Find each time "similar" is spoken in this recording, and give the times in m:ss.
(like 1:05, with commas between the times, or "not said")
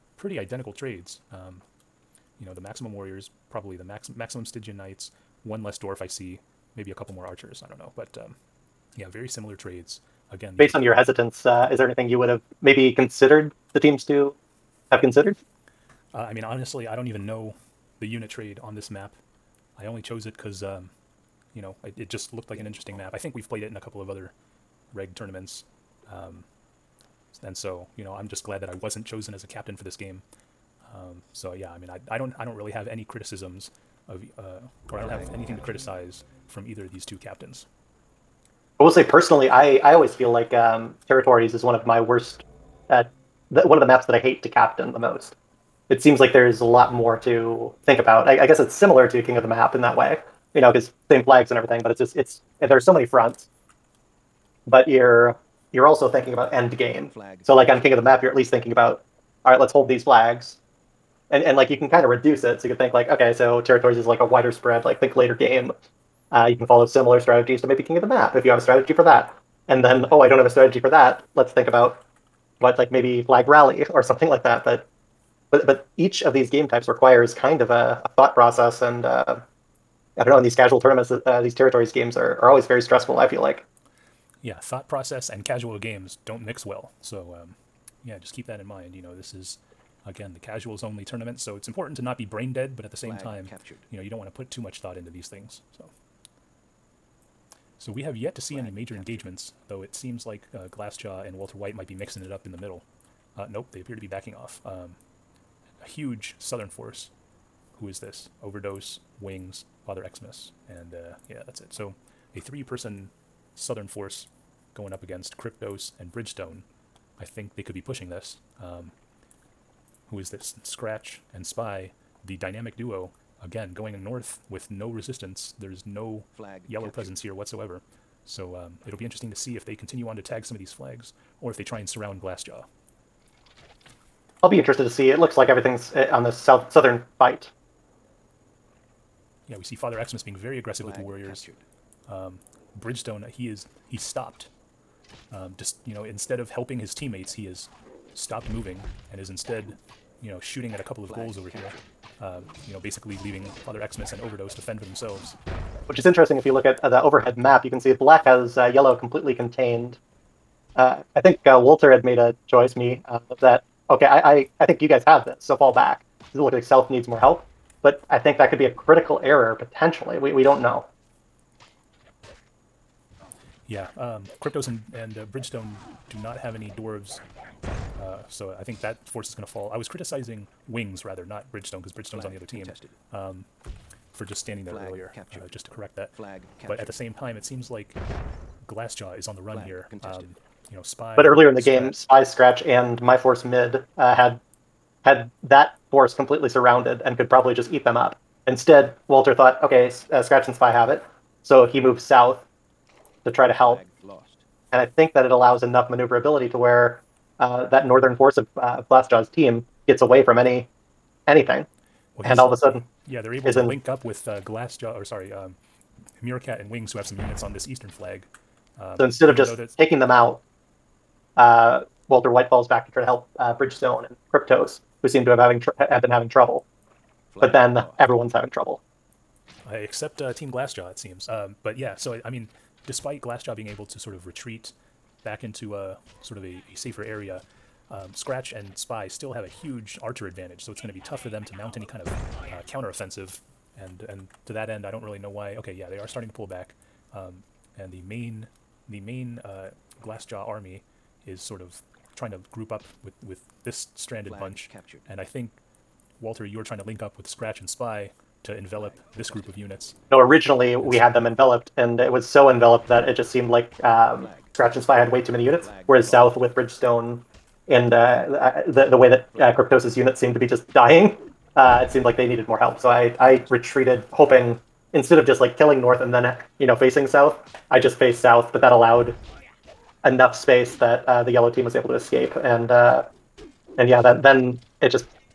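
0:09, 0:48, 1:06.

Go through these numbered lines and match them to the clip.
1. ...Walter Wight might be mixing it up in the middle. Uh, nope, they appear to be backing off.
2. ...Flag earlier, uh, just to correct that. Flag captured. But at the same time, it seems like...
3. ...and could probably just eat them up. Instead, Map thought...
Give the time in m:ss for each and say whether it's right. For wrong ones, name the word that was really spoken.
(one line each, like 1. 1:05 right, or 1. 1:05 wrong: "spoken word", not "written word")
1. 1:41 right
2. 3:04 right
3. 3:17 wrong: "Walter", not "Map".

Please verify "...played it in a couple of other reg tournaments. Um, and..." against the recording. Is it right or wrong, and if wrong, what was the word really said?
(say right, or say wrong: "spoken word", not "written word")
right.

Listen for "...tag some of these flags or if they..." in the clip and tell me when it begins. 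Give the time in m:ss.
2:10.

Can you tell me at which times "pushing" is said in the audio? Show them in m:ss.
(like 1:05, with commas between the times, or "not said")
1:57.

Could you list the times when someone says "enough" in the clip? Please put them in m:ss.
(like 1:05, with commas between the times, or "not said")
3:25, 4:40.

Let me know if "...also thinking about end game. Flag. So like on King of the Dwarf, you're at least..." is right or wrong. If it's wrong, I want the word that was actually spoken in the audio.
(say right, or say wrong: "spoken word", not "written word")
wrong: "Map", not "Dwarf".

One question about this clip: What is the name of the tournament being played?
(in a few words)
Casuals only tournament.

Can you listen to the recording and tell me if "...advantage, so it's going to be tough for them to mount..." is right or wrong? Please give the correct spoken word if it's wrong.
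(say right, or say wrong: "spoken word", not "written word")
right.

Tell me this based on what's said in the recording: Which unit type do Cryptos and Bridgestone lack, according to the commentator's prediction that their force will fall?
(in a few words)
Dwarves.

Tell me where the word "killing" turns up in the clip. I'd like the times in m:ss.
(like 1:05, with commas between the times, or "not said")
4:35.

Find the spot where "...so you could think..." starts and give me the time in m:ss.
1:02.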